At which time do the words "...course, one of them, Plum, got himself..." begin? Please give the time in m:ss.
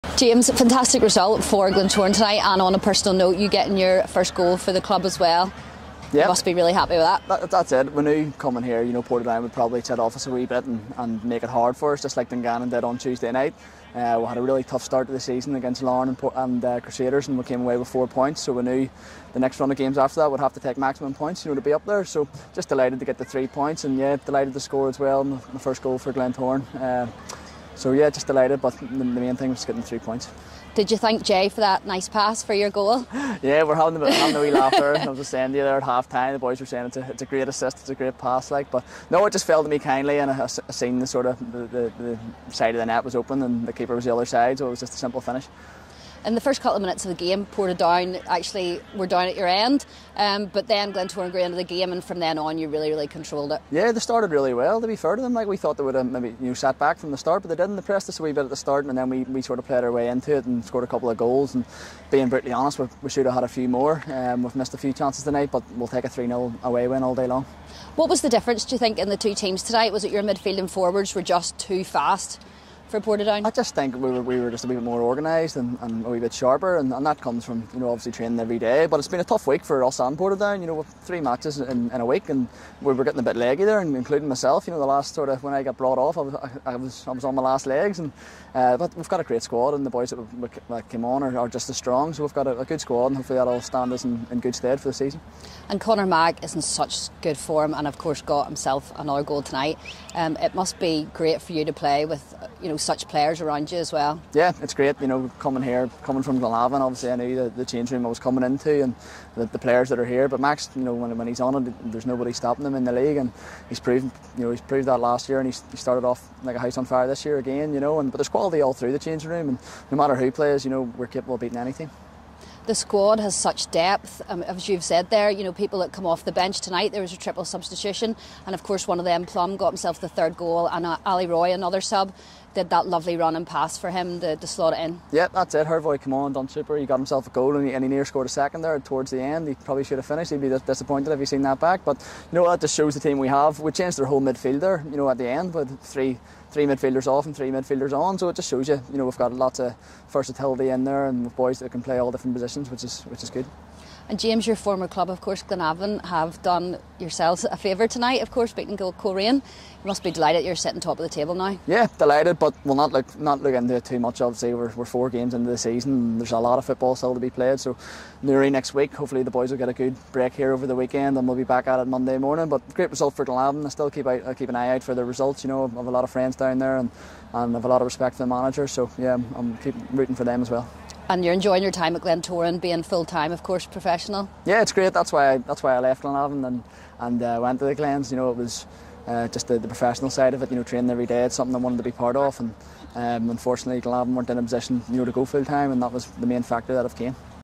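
2:08.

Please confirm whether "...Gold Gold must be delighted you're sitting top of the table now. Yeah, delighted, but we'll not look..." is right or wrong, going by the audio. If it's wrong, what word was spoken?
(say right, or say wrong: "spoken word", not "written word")
wrong: "You", not "Gold".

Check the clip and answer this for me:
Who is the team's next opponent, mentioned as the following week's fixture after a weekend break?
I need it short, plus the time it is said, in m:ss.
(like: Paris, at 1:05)
Newry, at 2:48.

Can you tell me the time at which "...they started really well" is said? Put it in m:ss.
0:53.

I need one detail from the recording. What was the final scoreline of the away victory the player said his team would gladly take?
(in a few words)
3-0.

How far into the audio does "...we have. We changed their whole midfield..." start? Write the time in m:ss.
2:23.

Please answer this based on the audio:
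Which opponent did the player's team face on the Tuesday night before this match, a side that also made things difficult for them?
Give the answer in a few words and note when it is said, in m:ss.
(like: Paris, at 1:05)
Dungannon, at 0:12.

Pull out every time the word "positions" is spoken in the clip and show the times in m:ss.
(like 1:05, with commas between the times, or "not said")
2:32, 3:14.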